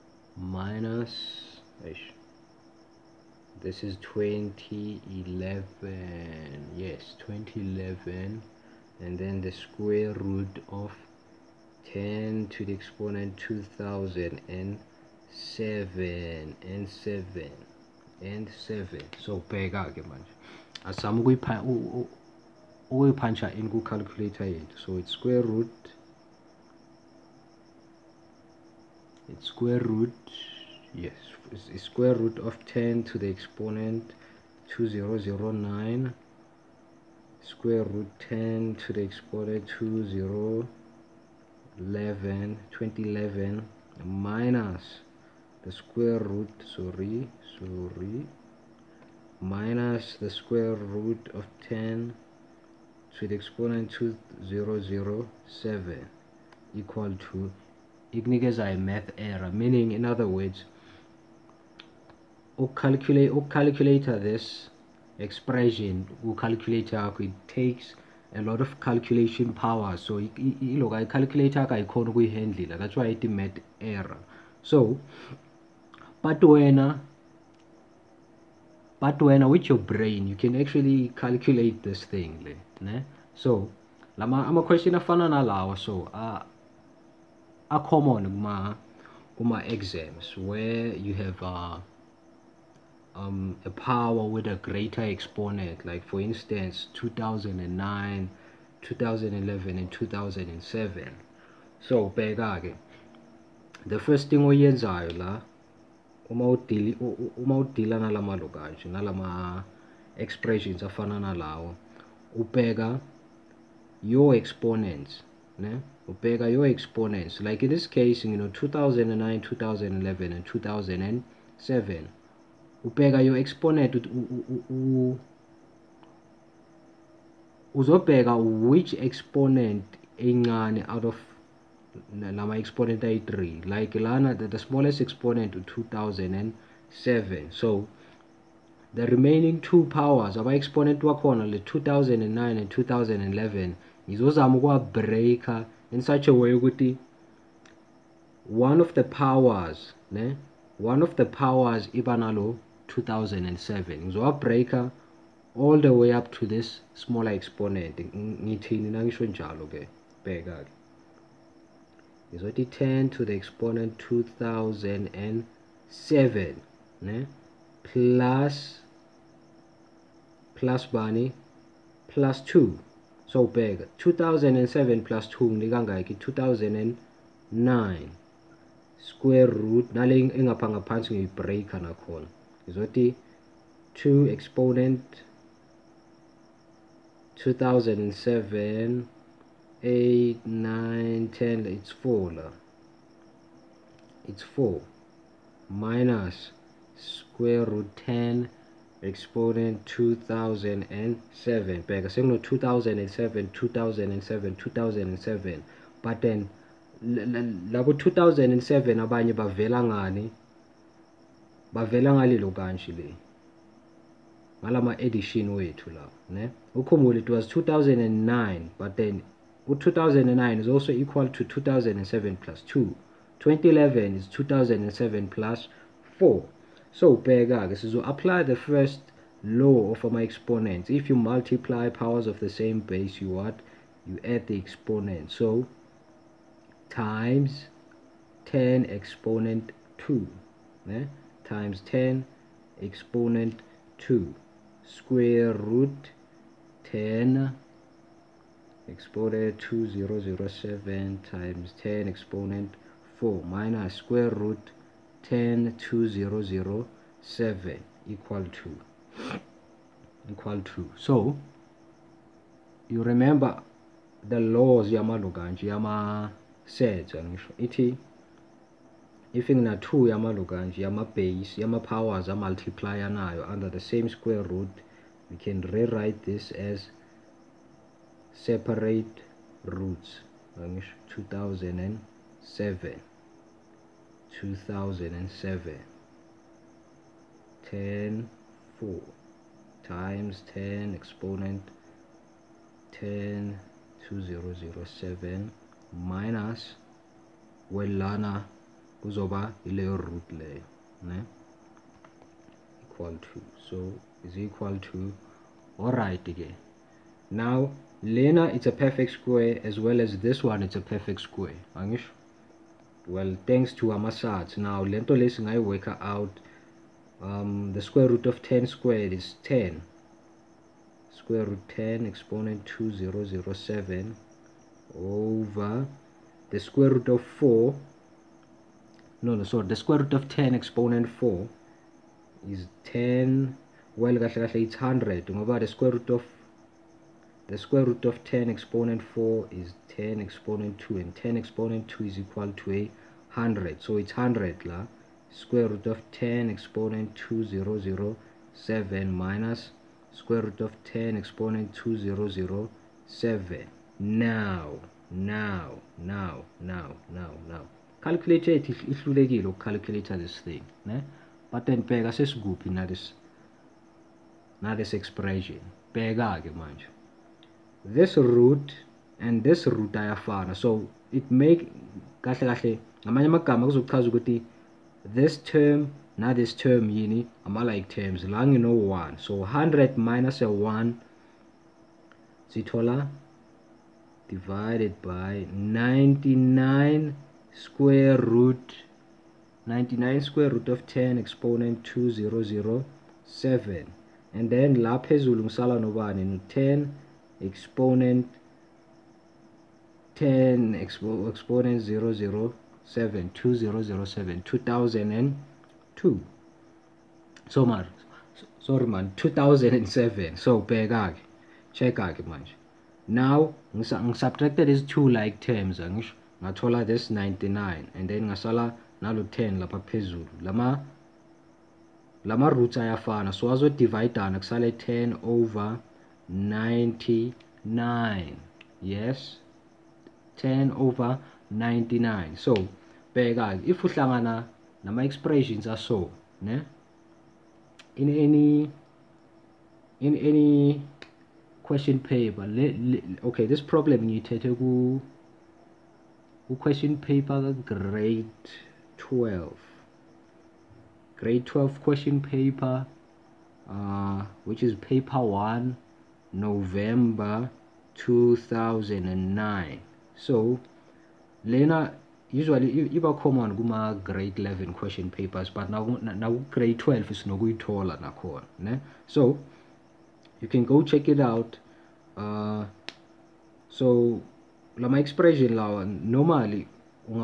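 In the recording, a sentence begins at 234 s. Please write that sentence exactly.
you add the exponent so times 10 exponent 2 yeah?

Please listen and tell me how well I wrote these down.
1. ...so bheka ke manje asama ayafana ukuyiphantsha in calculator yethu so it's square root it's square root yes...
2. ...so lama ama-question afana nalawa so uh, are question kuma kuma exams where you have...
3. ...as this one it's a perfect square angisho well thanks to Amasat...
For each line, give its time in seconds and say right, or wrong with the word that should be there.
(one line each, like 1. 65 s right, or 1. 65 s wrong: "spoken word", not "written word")
1. 19 s wrong: "ukuyiphana", not "ayafana"
2. 83 s wrong: "common", not "question"
3. 309 s right.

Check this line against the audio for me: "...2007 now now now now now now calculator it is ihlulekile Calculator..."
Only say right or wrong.
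right.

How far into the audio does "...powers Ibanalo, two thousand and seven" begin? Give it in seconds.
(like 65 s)
151 s.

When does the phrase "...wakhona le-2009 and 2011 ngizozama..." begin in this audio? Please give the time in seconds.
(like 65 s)
141 s.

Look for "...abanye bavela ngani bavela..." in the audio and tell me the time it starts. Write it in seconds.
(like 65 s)
208 s.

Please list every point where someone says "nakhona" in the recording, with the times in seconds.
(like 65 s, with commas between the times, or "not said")
181 s, 467 s.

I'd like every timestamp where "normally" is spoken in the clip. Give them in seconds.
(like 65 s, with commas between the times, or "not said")
475 s.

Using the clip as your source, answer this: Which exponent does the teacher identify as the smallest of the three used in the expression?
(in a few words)
2007.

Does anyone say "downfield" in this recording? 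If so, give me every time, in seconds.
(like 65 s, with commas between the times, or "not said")
not said.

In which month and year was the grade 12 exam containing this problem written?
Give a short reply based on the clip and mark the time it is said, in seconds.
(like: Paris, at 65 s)
November 2009, at 456 s.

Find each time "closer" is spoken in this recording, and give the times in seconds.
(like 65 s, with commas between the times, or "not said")
not said.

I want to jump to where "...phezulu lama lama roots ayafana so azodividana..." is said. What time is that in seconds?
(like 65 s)
419 s.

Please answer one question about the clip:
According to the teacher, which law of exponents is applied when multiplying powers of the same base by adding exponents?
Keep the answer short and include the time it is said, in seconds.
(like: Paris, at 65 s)
first law, at 228 s.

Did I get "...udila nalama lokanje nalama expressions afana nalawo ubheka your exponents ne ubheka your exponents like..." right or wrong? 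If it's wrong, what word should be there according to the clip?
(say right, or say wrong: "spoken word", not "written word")
right.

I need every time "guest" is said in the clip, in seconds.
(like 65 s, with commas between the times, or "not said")
not said.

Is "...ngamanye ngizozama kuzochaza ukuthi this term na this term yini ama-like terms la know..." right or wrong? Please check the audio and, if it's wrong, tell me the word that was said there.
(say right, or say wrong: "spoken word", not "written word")
wrong: "amagama", not "ngizozama".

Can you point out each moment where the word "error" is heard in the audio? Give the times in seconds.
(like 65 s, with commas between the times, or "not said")
59 s, 73 s.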